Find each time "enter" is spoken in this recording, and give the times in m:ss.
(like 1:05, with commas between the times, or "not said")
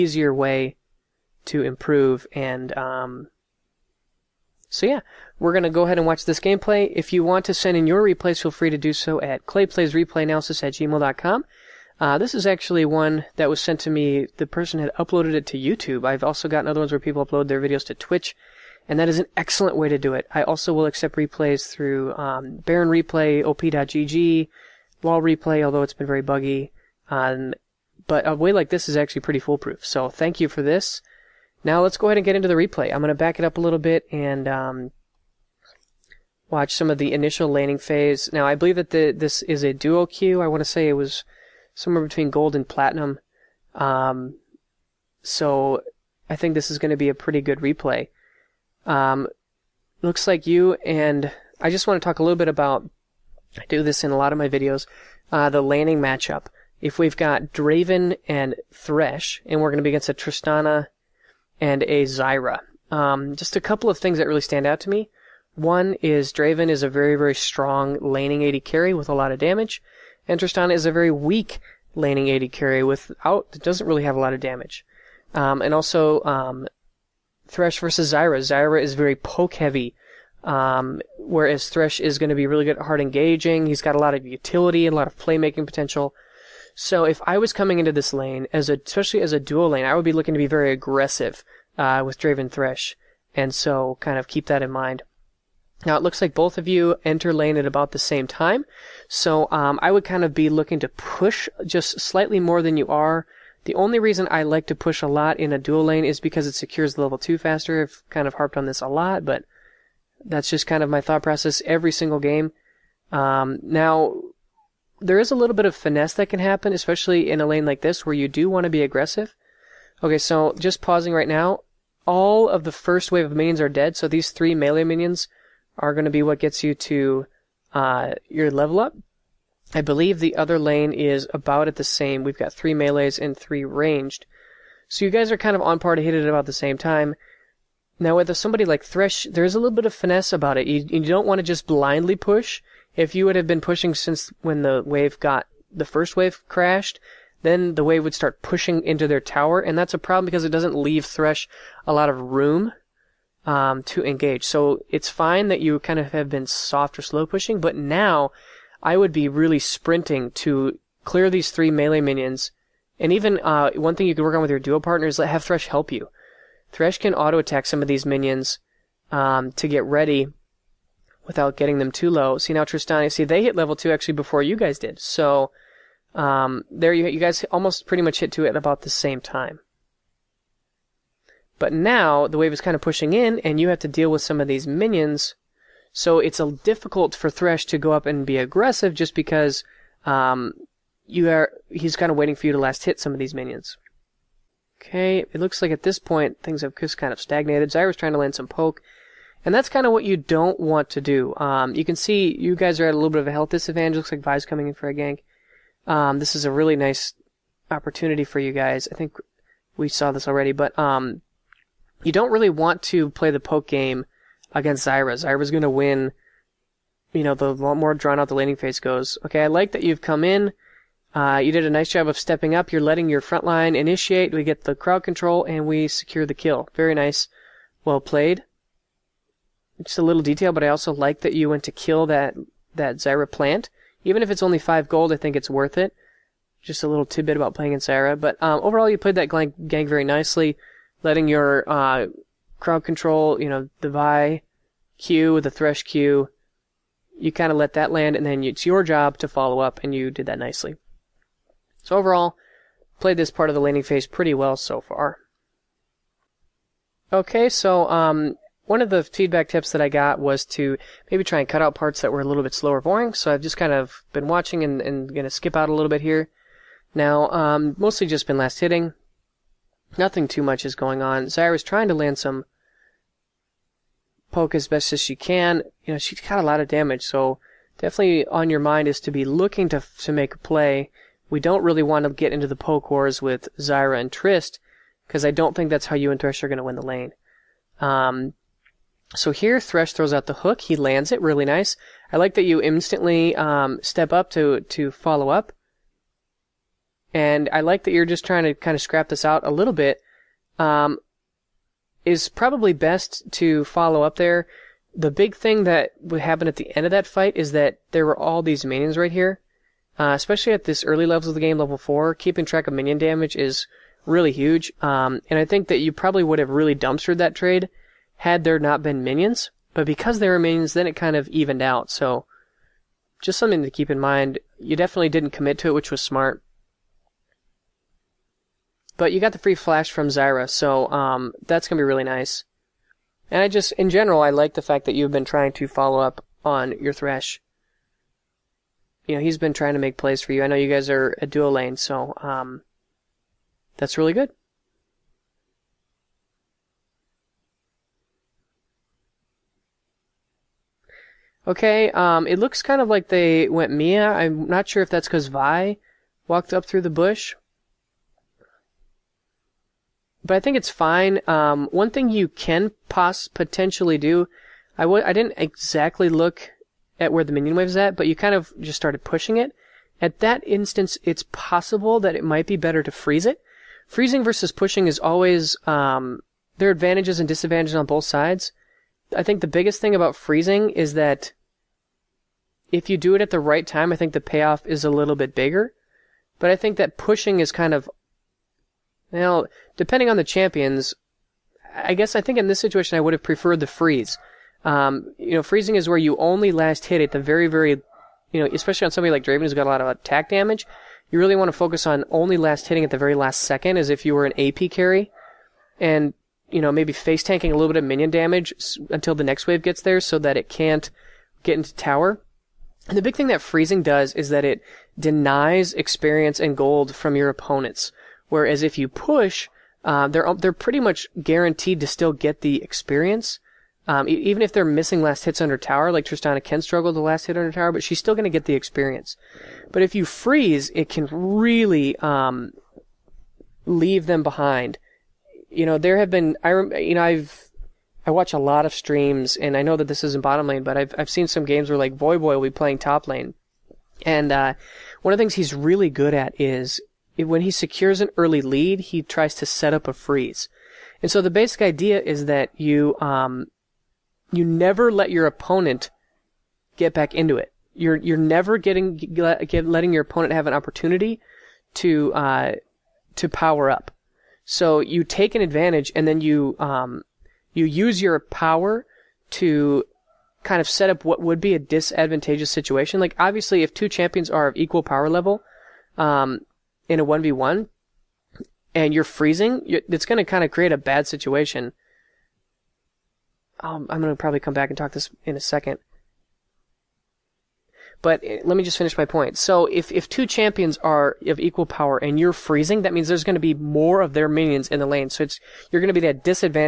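1:37.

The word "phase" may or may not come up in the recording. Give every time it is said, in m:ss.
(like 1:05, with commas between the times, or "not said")
0:37, 3:38, 4:13.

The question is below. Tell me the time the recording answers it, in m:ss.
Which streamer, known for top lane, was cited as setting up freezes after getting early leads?
7:21.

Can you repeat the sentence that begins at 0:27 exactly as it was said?
Um, but a way like this is actually pretty foolproof.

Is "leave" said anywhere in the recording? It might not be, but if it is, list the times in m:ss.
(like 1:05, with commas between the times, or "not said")
2:30, 7:13.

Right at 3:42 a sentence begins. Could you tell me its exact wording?
You're letting your front line initiate.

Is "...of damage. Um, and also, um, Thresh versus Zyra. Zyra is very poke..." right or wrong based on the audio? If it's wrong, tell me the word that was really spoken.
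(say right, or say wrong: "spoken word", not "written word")
right.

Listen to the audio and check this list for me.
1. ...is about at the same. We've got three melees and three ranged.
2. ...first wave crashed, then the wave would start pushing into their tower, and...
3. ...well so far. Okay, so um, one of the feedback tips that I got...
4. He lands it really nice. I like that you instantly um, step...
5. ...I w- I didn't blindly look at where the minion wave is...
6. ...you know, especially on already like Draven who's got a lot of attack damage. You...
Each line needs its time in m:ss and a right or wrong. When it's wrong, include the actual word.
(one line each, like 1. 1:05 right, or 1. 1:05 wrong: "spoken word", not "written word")
1. 2:10 right
2. 2:25 right
3. 4:14 right
4. 4:50 right
5. 6:04 wrong: "exactly", not "blindly"
6. 6:38 wrong: "somebody", not "already".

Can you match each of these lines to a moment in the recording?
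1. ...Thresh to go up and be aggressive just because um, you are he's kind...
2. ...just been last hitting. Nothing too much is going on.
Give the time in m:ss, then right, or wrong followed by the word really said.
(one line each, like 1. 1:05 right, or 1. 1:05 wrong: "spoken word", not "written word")
1. 3:07 right
2. 4:28 right.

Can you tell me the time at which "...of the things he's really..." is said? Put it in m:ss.
7:25.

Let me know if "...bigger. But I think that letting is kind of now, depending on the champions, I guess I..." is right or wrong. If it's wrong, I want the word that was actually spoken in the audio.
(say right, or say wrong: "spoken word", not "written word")
wrong: "pushing", not "letting".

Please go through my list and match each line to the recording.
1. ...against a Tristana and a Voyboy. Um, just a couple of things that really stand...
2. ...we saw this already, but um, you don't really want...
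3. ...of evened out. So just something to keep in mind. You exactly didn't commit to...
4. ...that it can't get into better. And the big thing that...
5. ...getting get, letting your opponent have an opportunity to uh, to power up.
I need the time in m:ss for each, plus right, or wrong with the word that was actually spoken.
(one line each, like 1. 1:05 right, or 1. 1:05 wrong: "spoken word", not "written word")
1. 0:59 wrong: "Zyra", not "Voyboy"
2. 3:29 right
3. 5:21 wrong: "definitely", not "exactly"
4. 6:50 wrong: "tower", not "better"
5. 7:38 right.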